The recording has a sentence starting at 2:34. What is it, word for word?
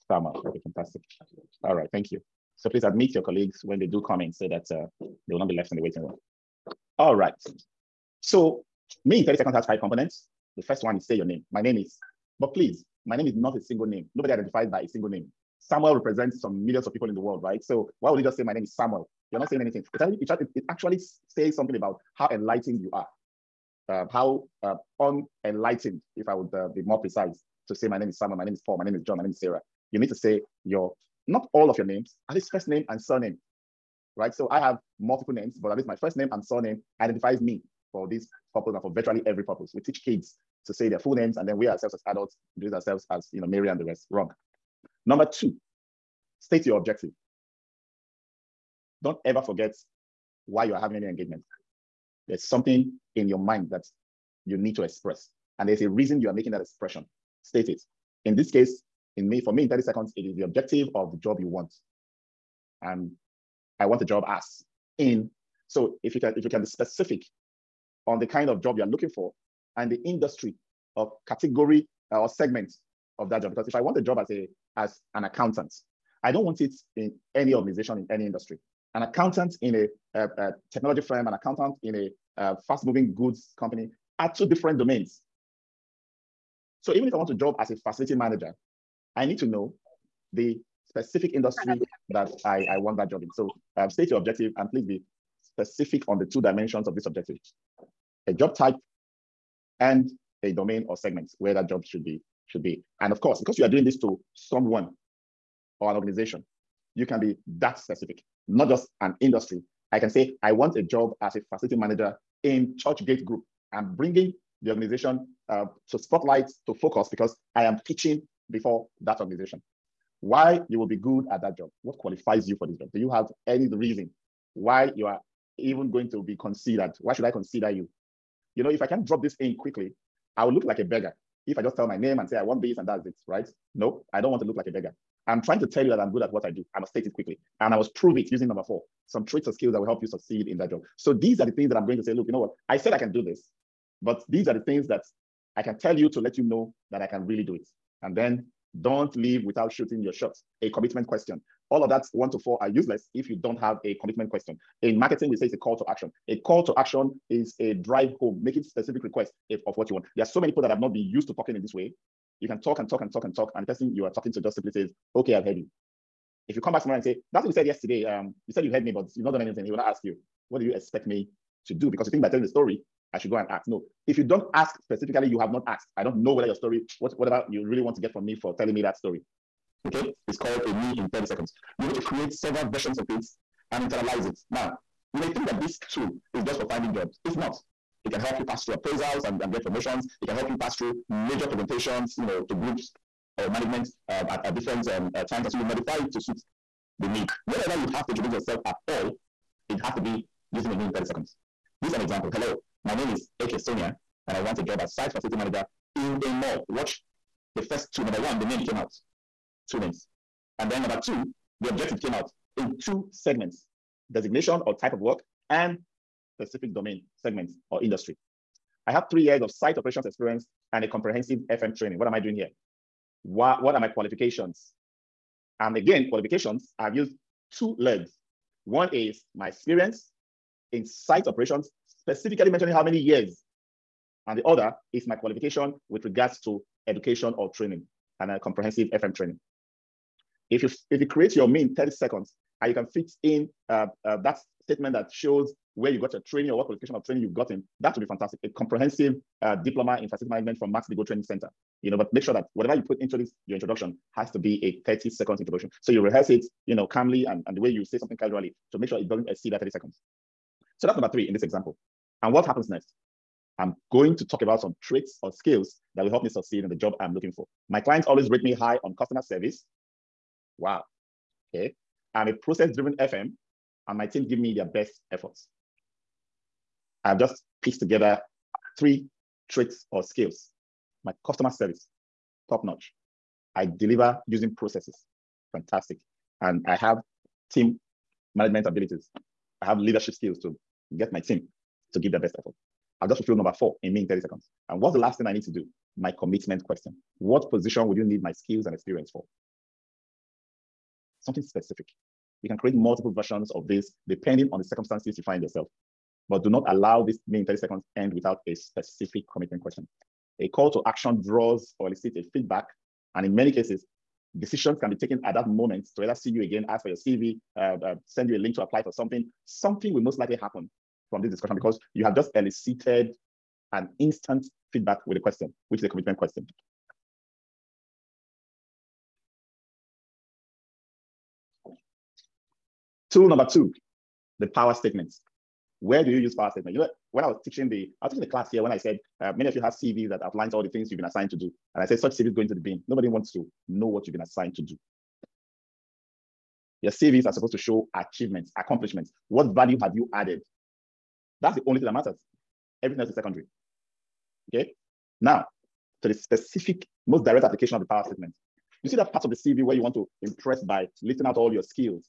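In marketing, we say it's a call to action.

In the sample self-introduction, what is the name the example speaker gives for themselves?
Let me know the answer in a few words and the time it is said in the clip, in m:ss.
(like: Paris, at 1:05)
AK Sonia, at 3:23.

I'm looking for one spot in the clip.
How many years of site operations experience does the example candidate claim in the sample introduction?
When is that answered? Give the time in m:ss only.
3:39.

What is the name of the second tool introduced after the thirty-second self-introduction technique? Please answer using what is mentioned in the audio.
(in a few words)
Power statements.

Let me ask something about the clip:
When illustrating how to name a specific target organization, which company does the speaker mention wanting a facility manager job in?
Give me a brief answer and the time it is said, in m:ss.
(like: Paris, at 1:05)
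Churchgate Group, at 1:52.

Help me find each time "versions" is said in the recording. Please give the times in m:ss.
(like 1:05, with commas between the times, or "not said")
3:02, 5:03.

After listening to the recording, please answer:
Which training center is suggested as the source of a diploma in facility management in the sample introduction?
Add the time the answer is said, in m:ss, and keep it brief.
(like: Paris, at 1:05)
Max-Migold Training Center, at 4:10.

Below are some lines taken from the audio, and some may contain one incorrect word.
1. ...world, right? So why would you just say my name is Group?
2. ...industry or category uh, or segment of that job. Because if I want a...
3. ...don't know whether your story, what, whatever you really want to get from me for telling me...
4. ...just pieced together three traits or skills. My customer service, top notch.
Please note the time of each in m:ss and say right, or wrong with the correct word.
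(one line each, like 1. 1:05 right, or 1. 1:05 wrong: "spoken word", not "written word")
1. 0:17 wrong: "Samuel", not "Group"
2. 1:10 right
3. 2:56 right
4. 4:37 right.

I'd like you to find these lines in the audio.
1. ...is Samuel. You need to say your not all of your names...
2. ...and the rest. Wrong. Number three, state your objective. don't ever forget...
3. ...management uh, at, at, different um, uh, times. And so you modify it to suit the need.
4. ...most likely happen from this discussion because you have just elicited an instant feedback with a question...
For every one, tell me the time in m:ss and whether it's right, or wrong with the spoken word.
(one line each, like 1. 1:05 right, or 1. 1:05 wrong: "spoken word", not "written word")
1. 0:29 wrong: "Sarah", not "Samuel"
2. 0:43 wrong: "two", not "three"
3. 3:13 right
4. 5:20 right.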